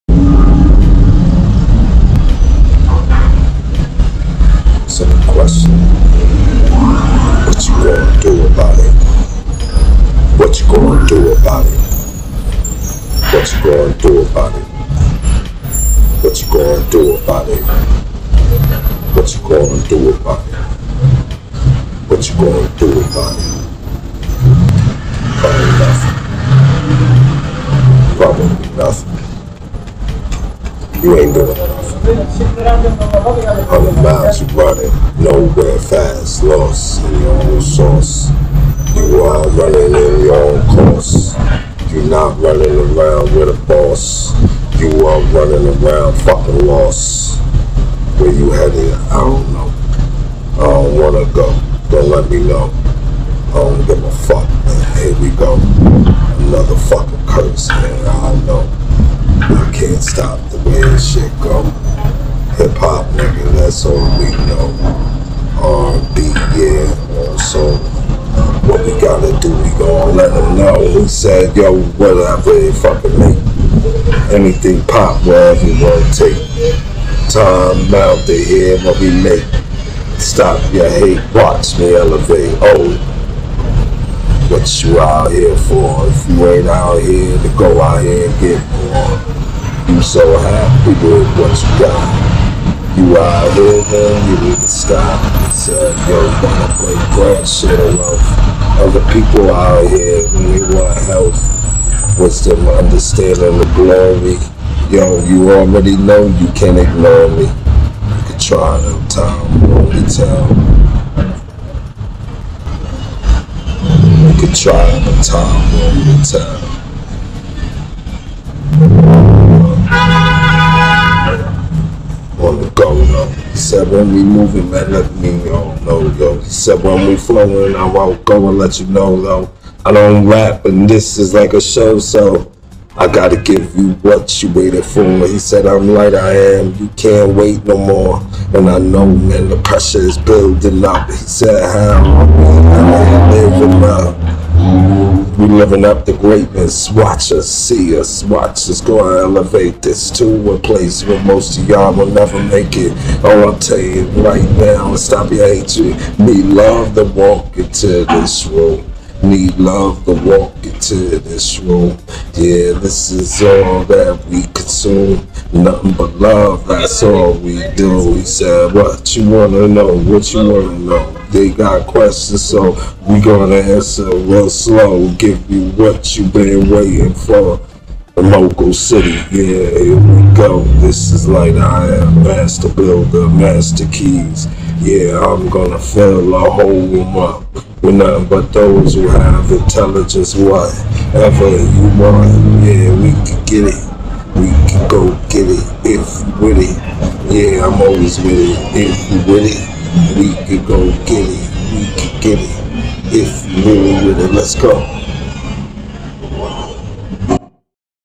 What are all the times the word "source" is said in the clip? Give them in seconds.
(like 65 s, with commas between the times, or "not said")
37 s.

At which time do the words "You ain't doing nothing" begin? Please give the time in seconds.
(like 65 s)
31 s.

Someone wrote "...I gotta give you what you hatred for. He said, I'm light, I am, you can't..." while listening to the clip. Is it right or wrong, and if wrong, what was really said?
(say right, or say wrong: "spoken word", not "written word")
wrong: "waited", not "hatred".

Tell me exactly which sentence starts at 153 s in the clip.
Oh, I'll tell you right now, stop your hatred.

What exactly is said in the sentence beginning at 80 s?
Stop your hate, watch me elevate.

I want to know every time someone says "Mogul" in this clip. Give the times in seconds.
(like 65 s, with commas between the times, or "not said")
178 s.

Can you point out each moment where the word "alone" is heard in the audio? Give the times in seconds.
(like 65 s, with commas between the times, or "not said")
97 s.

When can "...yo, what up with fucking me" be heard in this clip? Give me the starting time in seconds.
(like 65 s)
71 s.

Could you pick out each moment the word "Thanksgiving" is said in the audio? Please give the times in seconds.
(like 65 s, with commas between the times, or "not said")
not said.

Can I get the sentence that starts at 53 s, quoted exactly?
I don't give a fuck, man.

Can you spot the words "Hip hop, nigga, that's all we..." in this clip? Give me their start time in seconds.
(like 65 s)
62 s.